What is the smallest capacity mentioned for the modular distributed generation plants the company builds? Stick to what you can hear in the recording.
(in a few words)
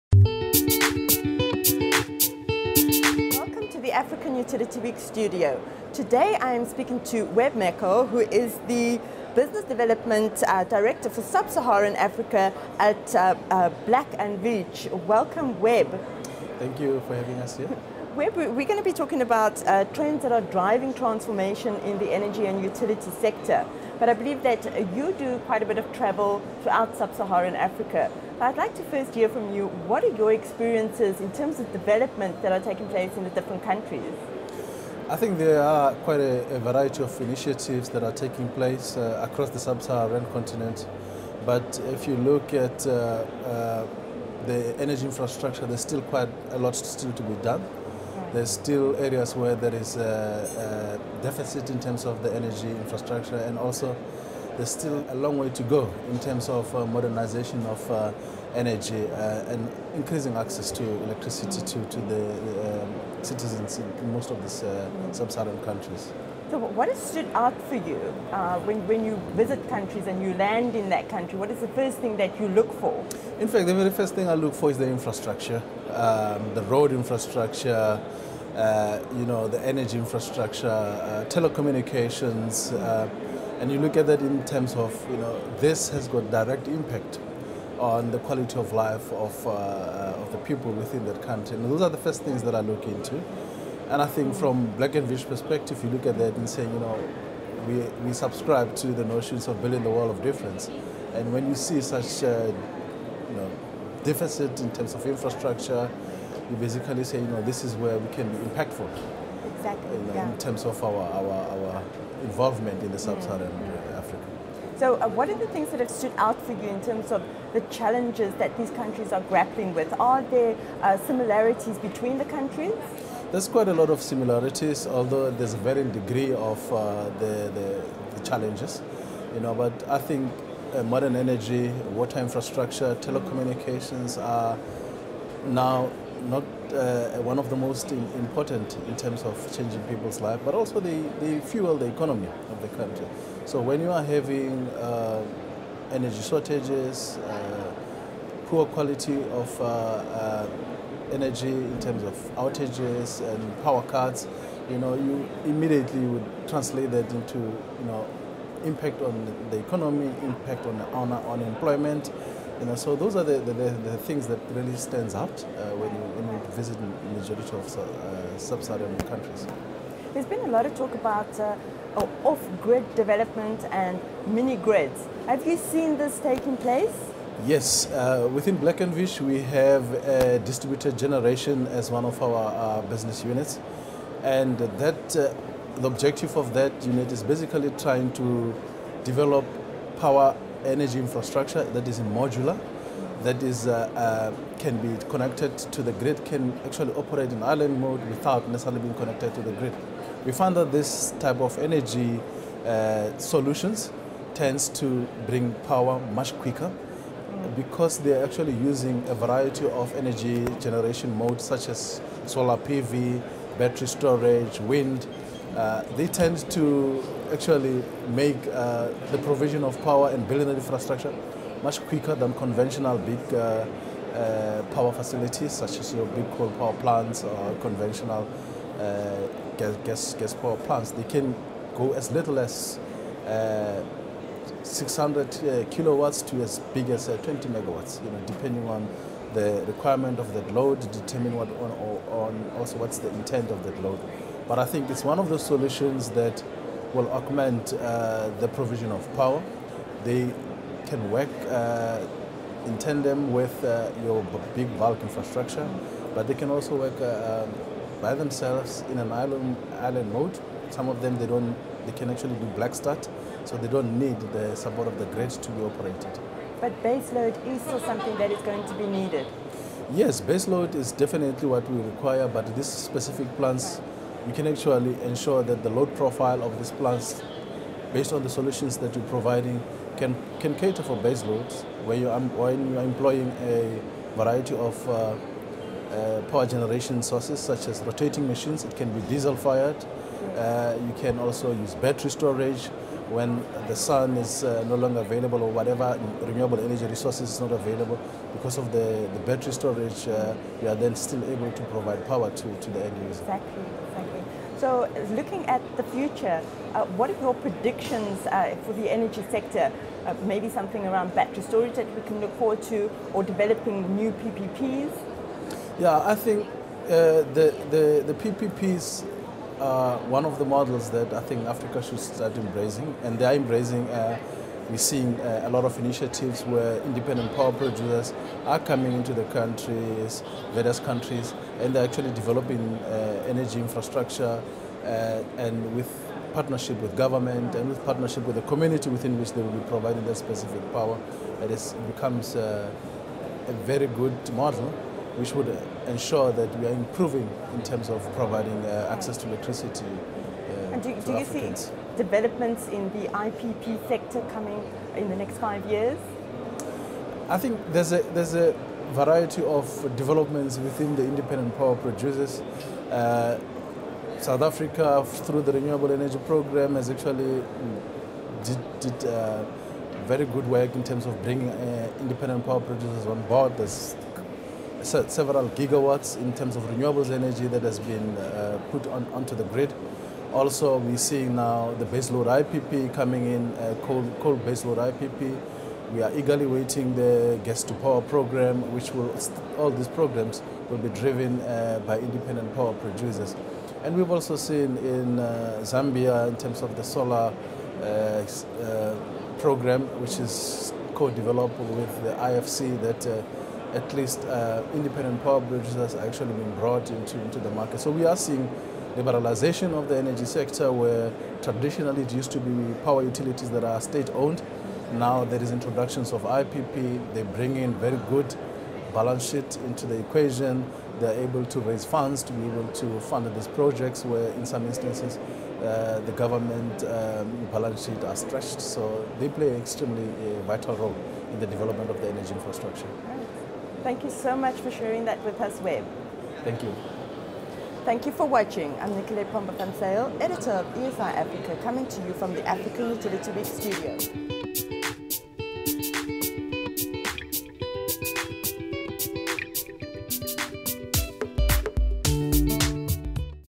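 600 kilowatts.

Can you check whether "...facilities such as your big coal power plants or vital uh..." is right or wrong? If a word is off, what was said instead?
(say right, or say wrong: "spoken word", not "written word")
wrong: "conventional", not "vital".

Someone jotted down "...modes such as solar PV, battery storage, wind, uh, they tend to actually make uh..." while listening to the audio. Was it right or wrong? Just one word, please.
right.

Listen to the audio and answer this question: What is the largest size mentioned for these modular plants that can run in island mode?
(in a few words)
20 megawatts.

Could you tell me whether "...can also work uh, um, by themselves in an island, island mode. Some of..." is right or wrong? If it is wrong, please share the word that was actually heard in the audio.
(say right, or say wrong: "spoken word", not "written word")
right.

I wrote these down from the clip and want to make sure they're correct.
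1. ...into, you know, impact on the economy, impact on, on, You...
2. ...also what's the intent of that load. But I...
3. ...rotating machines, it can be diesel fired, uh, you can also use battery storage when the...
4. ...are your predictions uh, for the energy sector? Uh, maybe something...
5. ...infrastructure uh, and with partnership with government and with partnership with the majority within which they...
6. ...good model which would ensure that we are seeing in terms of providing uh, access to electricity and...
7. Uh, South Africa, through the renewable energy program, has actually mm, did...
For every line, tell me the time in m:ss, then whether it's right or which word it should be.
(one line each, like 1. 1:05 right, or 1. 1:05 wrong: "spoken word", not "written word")
1. 2:37 right
2. 4:02 right
3. 4:47 right
4. 5:07 right
5. 5:33 wrong: "community", not "majority"
6. 5:43 wrong: "improving", not "seeing"
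7. 6:02 right.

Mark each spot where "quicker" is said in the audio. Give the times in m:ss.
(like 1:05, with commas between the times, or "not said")
3:26, 3:41.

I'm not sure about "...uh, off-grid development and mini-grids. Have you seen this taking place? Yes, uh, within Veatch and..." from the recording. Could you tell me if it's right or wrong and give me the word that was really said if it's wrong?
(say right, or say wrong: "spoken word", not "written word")
wrong: "Black", not "Veatch".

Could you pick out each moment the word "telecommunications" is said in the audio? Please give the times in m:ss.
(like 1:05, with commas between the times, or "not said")
1:21, 2:13.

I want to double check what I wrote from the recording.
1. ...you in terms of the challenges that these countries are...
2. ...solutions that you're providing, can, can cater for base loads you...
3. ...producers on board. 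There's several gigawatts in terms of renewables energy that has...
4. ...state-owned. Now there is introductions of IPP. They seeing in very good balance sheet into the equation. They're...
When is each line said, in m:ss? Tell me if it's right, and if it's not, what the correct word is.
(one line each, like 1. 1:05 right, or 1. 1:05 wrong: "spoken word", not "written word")
1. 1:56 right
2. 4:38 right
3. 6:12 right
4. 6:53 wrong: "bring", not "seeing".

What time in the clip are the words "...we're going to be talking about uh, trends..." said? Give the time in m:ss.
0:18.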